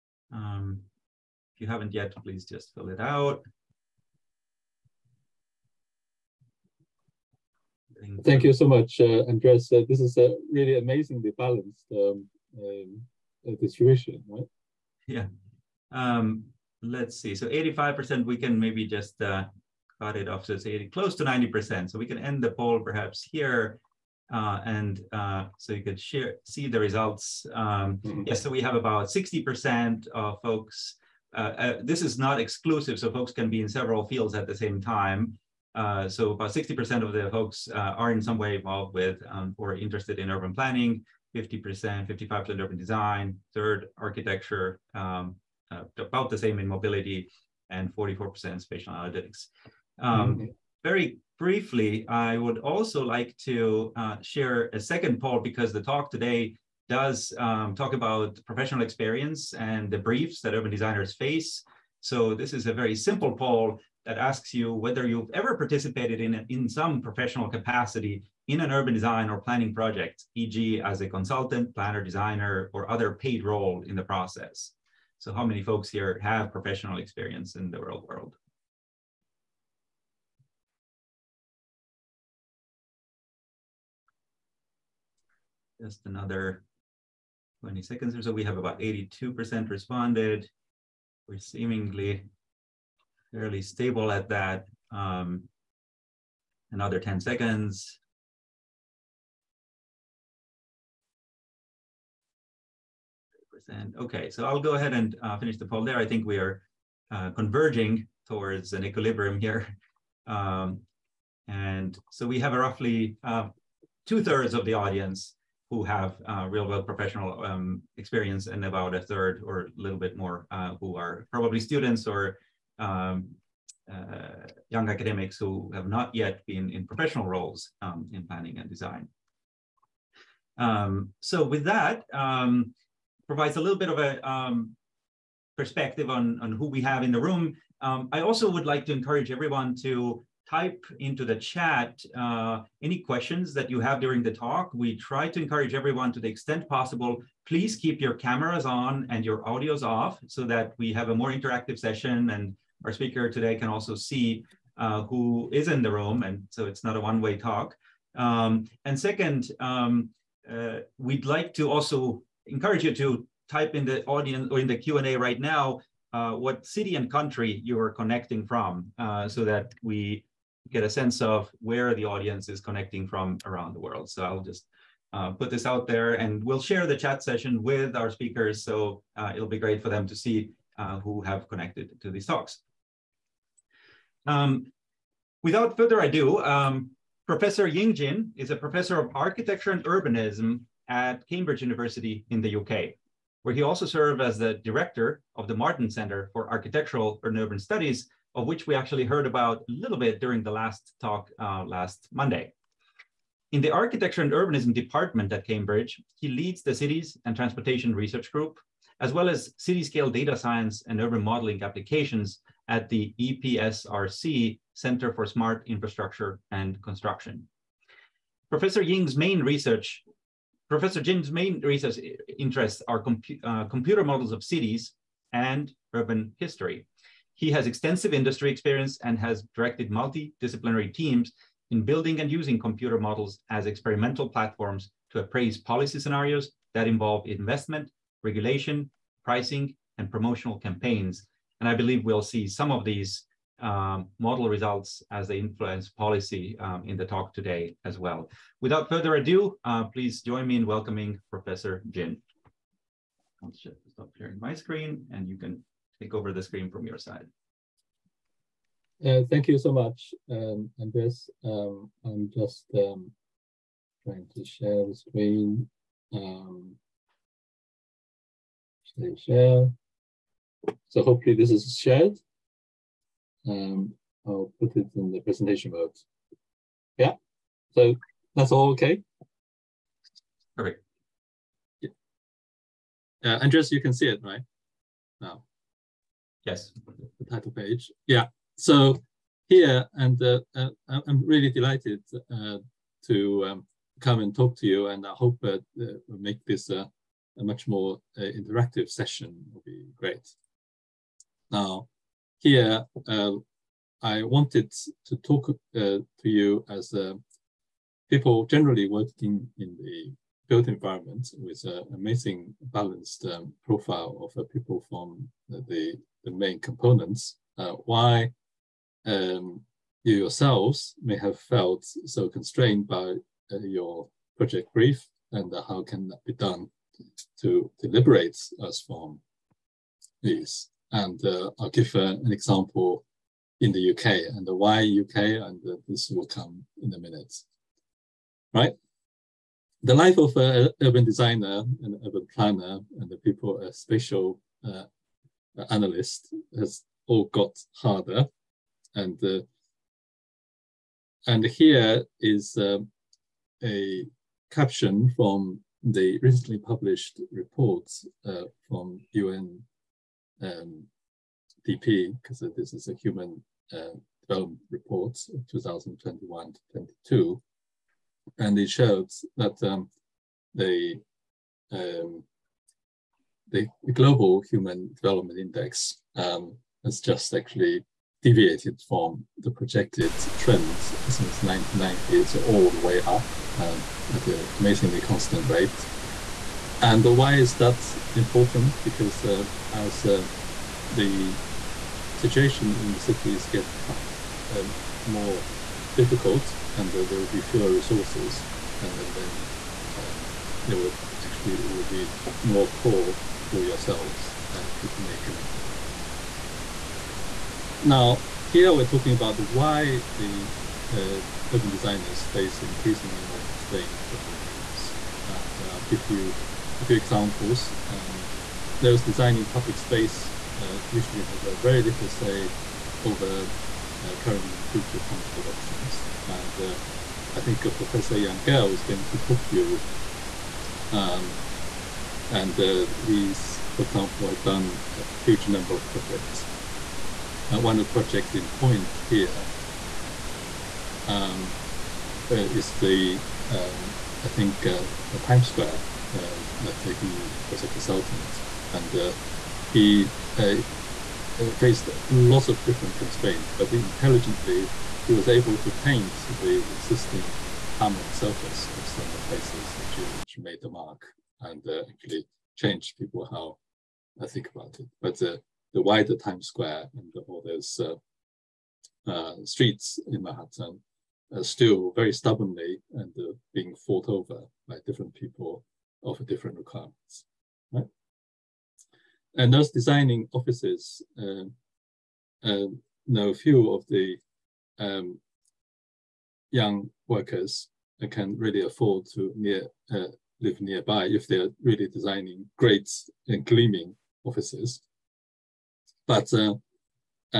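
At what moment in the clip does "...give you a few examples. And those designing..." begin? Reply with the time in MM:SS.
06:55.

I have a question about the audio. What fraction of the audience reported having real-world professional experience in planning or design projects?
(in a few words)
two thirds.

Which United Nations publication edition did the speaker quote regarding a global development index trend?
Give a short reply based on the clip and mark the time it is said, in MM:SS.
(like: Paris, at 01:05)
Human Development Report 2021-22, at 06:02.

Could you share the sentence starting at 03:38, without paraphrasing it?
Professor Ying's main research, Professor Jin's main research interests are compu uh, computer models of cities and urban history.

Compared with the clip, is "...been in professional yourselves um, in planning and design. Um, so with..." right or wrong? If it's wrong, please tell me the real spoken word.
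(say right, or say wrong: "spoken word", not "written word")
wrong: "roles", not "yourselves".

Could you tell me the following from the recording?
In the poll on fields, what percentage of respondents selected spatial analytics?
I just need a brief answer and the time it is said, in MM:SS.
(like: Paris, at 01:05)
44%, at 00:47.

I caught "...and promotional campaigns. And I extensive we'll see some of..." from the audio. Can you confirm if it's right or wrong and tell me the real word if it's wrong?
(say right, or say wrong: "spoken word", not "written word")
wrong: "believe", not "extensive".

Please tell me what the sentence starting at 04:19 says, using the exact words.
Uh, thank you so much, um, Andres.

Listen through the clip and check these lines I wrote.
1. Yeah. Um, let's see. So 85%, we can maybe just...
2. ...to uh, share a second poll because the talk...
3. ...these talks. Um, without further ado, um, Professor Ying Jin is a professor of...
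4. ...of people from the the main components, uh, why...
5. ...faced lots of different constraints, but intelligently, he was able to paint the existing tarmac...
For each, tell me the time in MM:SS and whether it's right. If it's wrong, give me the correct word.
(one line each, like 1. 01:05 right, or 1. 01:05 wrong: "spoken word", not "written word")
1. 00:15 right
2. 00:53 right
3. 03:02 right
4. 05:14 right
5. 07:31 right.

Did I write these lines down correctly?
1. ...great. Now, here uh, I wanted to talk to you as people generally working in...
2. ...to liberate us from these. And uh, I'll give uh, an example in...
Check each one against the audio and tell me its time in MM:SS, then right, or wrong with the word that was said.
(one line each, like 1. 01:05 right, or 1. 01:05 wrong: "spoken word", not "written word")
1. 04:59 right
2. 05:27 right.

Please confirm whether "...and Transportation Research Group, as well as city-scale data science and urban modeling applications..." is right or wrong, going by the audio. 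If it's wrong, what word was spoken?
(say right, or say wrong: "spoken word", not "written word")
right.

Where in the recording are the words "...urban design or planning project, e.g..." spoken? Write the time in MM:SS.
01:08.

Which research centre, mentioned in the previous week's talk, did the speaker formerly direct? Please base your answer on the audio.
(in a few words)
Martin Center.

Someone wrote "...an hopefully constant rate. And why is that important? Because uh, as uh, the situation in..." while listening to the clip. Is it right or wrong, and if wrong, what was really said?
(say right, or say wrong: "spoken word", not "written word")
wrong: "amazingly", not "hopefully".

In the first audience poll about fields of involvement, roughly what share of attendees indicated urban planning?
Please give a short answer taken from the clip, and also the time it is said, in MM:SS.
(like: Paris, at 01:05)
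60%, at 00:36.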